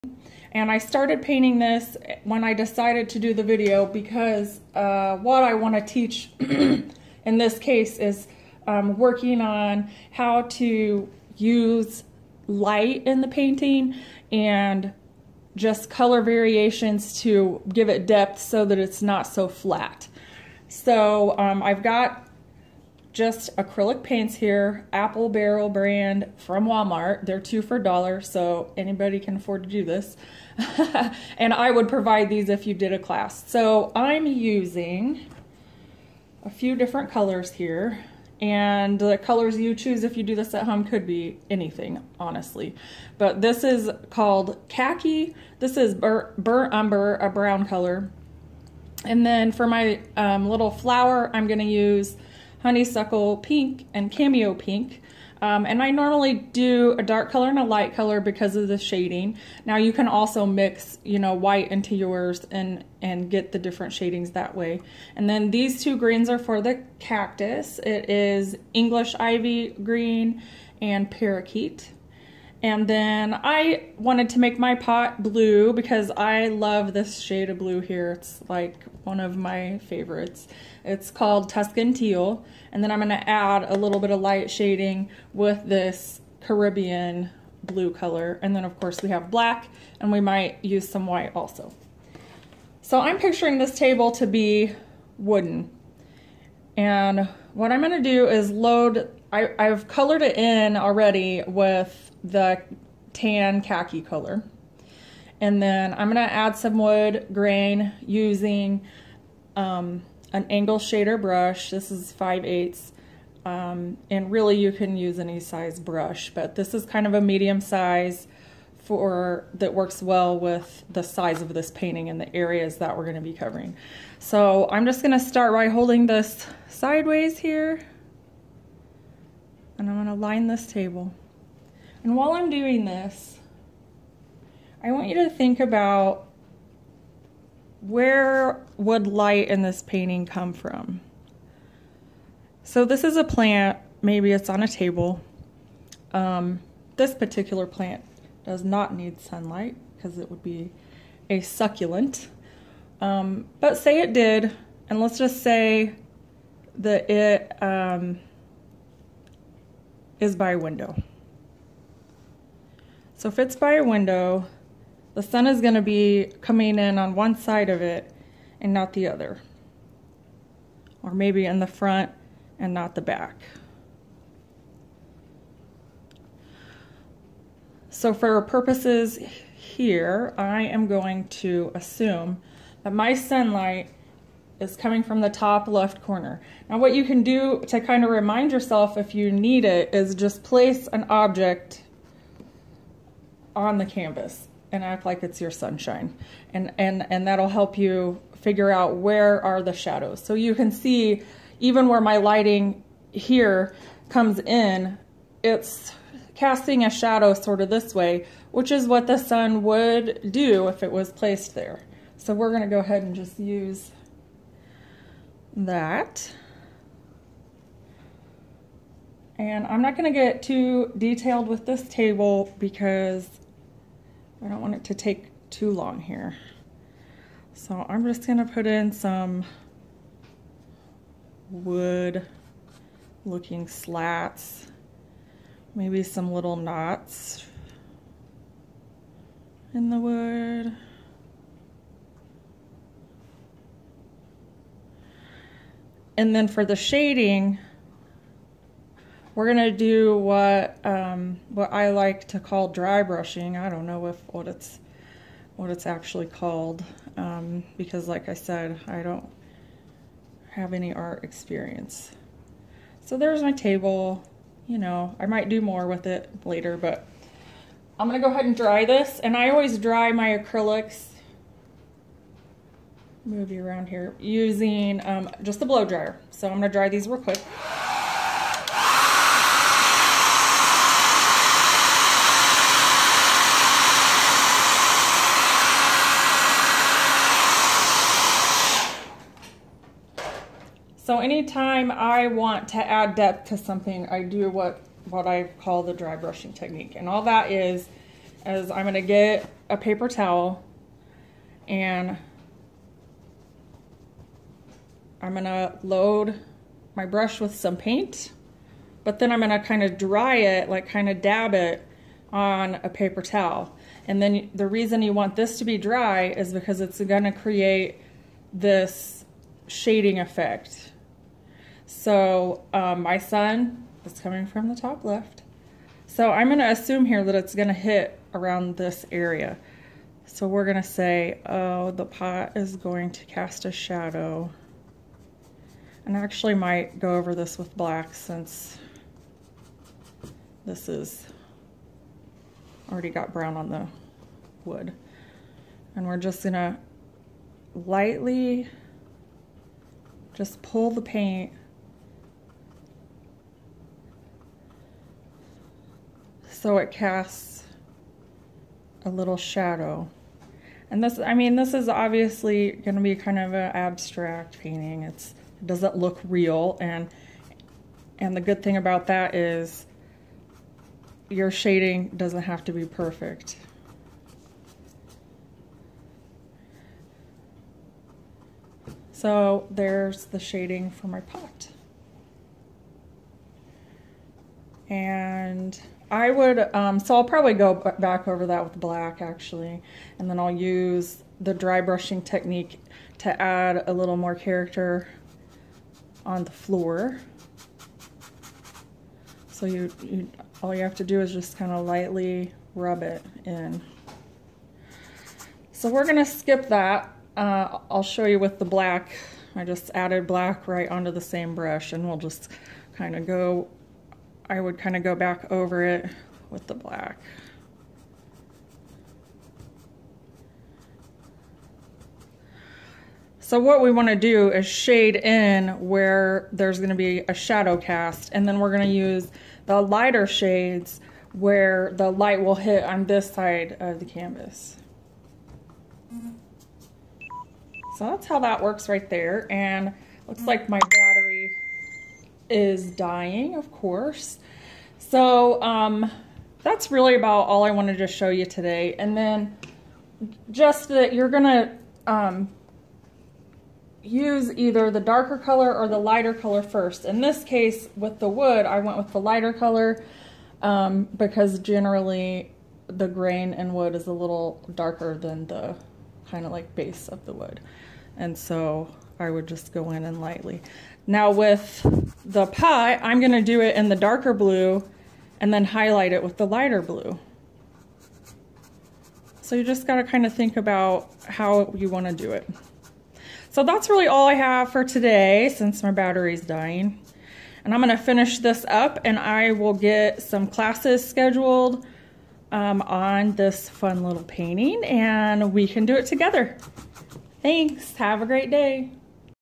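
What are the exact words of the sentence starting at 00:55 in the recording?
Um, and I normally do a dark color and a light color because of the shading.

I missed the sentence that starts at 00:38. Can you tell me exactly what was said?
And the colors you choose if you do this at home could be anything, honestly.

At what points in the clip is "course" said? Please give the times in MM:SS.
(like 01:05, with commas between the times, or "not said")
01:28, 07:23.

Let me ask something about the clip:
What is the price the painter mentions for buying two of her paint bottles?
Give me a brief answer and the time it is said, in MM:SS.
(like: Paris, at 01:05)
a dollar, at 00:27.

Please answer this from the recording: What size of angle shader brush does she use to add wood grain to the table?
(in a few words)
5/8.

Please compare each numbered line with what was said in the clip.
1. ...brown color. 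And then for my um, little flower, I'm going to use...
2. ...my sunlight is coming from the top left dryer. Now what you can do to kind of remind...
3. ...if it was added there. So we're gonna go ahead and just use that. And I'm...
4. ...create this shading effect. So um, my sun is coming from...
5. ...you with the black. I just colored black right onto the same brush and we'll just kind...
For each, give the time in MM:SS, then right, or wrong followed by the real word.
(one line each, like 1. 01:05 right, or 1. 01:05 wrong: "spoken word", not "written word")
1. 00:47 right
2. 03:02 wrong: "corner", not "dryer"
3. 03:30 wrong: "placed", not "added"
4. 05:17 right
5. 06:48 wrong: "added", not "colored".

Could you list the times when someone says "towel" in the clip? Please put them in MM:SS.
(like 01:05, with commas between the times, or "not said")
05:00, 05:13.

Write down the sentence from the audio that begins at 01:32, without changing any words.
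So I'm picturing this table to be wooden.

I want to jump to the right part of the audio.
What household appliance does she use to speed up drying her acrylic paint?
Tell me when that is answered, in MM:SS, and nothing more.
04:35.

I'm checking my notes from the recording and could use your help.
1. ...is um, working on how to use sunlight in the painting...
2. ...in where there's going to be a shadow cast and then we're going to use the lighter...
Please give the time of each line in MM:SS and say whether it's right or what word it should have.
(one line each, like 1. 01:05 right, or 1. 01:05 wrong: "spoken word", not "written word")
1. 00:07 wrong: "light", not "sunlight"
2. 07:05 right.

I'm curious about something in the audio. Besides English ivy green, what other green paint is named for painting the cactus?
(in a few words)
parakeet.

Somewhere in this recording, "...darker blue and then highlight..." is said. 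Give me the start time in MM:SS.
07:53.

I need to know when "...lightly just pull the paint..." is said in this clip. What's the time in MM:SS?
05:47.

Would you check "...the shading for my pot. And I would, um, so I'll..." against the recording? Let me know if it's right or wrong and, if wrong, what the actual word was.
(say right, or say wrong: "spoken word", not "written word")
right.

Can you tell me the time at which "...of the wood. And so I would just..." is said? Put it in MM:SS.
07:47.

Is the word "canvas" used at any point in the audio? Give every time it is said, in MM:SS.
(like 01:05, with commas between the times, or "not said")
03:13, 07:14.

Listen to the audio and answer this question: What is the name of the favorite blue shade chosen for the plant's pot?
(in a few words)
Tuscan Teal.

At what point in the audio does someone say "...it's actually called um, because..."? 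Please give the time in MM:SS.
04:15.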